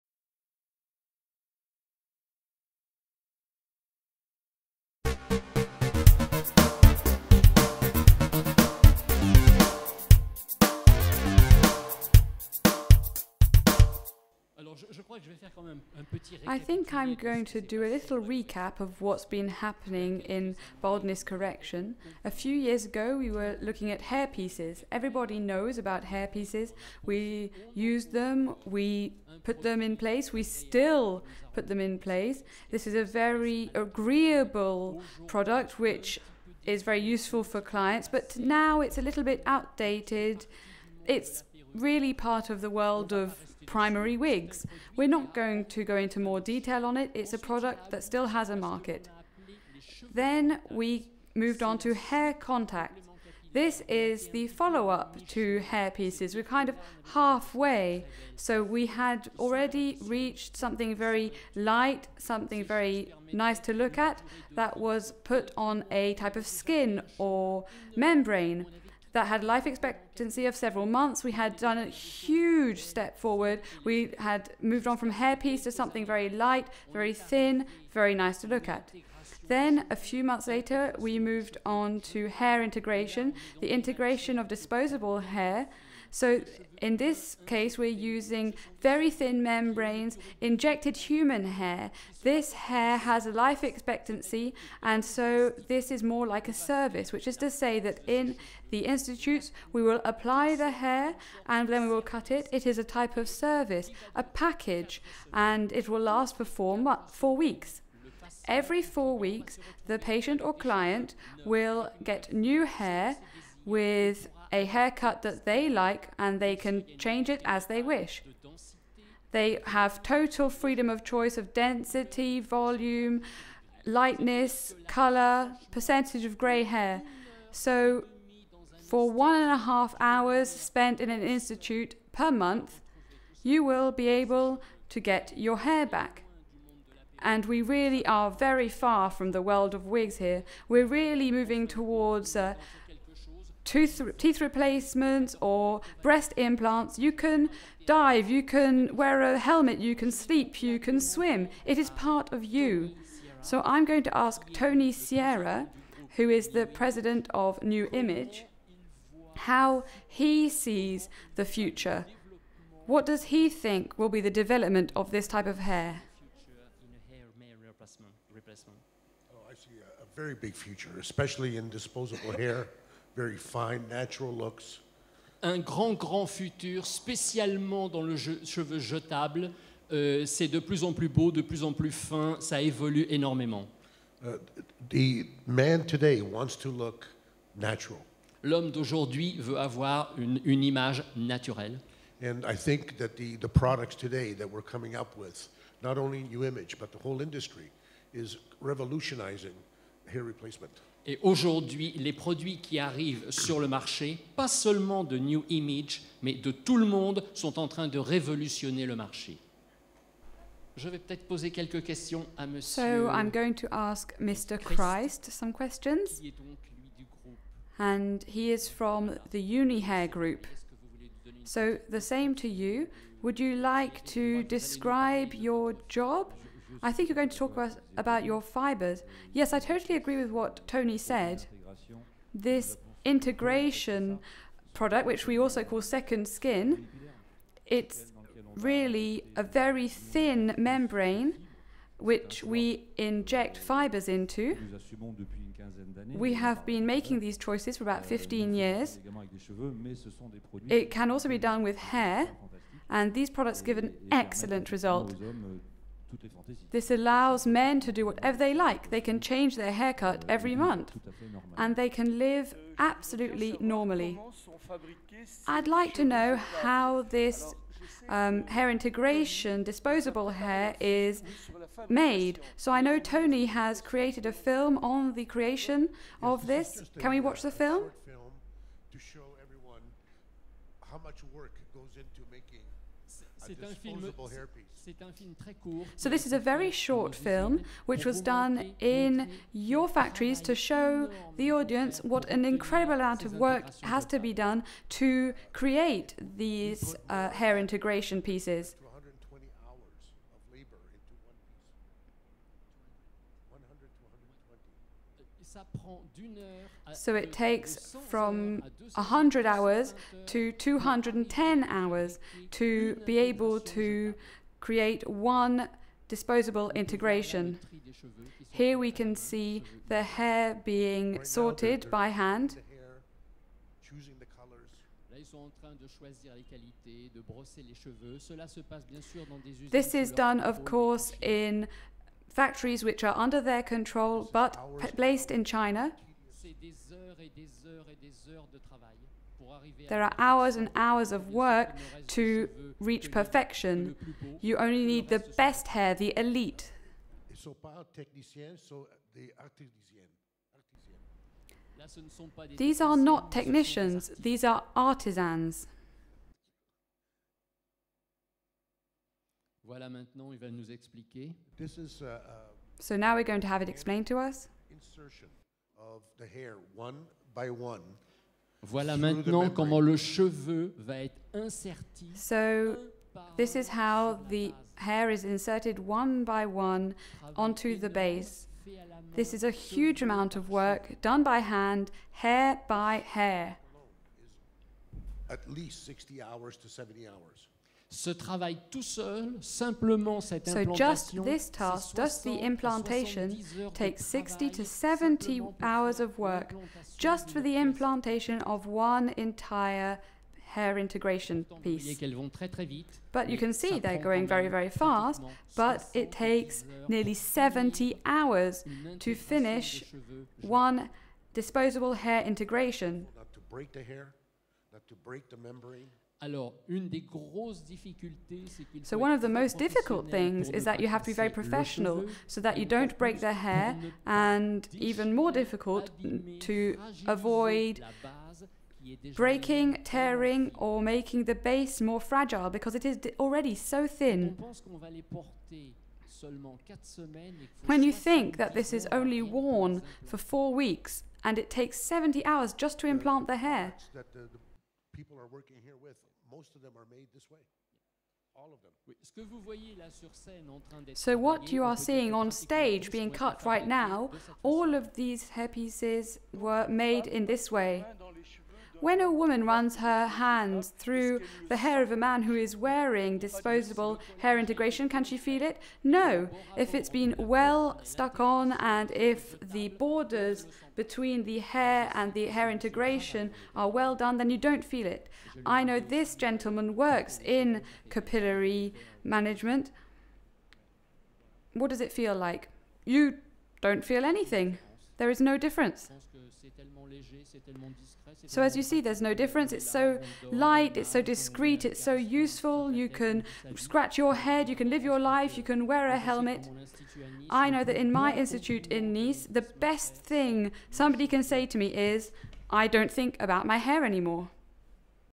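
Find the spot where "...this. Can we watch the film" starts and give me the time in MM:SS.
04:36.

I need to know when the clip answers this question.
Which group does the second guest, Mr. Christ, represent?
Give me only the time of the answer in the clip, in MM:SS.
03:39.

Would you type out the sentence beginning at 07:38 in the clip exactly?
When a woman runs her hand through the hair of a man who is wearing disposable hair integration, can she feel it?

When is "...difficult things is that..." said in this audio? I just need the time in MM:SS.
06:59.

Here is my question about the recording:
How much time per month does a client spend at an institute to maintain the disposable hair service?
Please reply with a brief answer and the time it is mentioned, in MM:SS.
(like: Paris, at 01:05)
1.5 hours, at 02:09.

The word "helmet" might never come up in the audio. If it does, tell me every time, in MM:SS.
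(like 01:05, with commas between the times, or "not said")
02:29, 08:15.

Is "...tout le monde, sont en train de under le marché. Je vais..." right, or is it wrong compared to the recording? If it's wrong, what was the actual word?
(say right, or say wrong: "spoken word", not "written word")
wrong: "révolutionner", not "under".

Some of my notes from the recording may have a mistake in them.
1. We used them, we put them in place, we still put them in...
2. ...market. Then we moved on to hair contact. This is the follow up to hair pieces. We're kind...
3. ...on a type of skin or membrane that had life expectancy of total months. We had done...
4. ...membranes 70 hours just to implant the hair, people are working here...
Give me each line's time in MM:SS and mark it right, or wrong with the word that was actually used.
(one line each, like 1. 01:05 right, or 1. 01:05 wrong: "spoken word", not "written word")
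1. 00:27 right
2. 00:48 right
3. 01:05 wrong: "several", not "total"
4. 07:21 wrong: "takes", not "membranes".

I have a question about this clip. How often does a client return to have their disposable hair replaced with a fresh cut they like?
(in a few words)
Every 4 weeks.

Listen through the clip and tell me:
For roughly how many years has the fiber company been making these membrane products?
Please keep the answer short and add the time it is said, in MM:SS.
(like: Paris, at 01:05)
15 years, at 04:07.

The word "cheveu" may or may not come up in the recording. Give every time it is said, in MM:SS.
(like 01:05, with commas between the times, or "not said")
02:58, 06:09.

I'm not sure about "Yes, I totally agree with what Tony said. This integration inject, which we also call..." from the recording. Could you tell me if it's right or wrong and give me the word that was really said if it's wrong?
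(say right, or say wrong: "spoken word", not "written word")
wrong: "product", not "inject".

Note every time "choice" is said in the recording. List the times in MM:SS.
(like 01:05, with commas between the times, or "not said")
02:01, 04:07.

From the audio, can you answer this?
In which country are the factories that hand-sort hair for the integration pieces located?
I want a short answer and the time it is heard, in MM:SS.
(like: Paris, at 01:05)
China, at 05:35.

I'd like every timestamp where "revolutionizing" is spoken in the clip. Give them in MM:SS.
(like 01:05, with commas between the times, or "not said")
03:18.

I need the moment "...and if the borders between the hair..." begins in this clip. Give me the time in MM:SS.
07:48.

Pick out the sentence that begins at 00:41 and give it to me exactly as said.
It's really part of the world of primary wigs.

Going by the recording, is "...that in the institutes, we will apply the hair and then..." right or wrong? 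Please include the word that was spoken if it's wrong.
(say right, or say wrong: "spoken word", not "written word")
right.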